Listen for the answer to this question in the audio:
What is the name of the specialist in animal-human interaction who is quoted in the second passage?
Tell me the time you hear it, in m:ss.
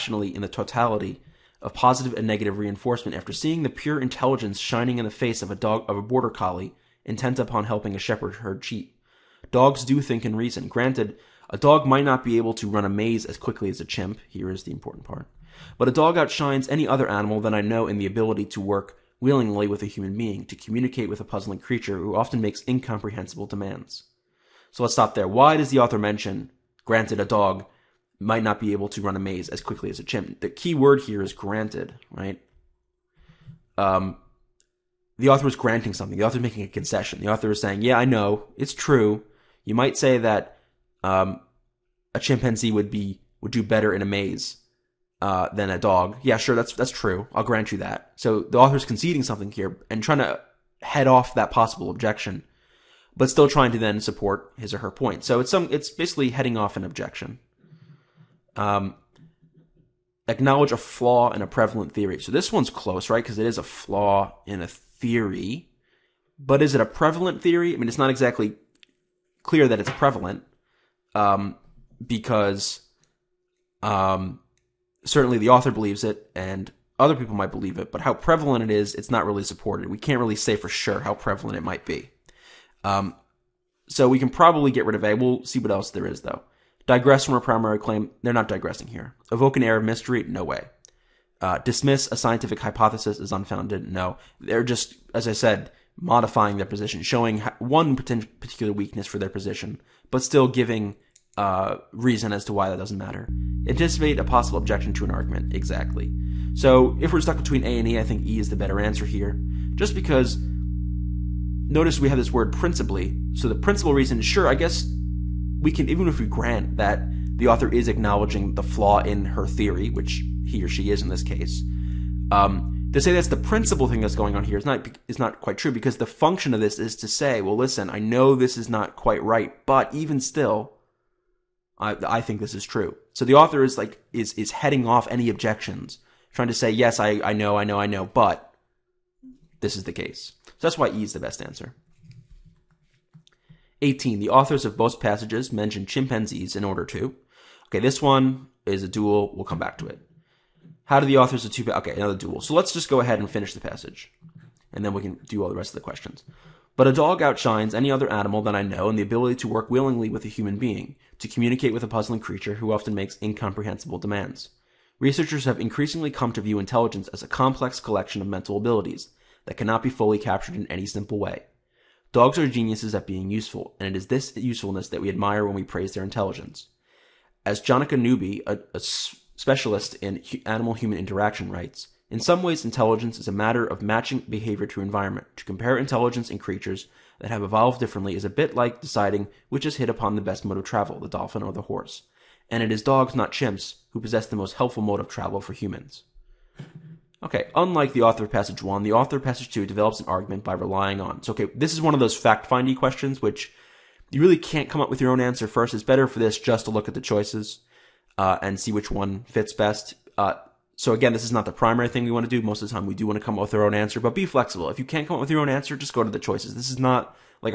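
2:57.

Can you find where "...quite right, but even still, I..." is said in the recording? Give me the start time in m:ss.
2:08.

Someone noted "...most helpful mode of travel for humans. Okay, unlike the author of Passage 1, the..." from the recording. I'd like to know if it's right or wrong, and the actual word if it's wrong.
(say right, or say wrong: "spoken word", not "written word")
right.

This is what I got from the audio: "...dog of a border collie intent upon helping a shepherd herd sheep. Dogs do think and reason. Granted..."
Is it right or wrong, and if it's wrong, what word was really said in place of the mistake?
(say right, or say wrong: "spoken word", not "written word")
right.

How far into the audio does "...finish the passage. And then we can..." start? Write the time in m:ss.
2:33.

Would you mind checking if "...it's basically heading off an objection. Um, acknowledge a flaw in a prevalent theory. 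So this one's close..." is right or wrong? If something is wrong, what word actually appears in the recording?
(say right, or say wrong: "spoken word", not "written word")
right.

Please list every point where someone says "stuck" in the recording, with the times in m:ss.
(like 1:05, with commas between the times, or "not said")
1:47.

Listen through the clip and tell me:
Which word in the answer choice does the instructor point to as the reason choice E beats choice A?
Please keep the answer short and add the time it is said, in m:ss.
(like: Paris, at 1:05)
principally, at 1:52.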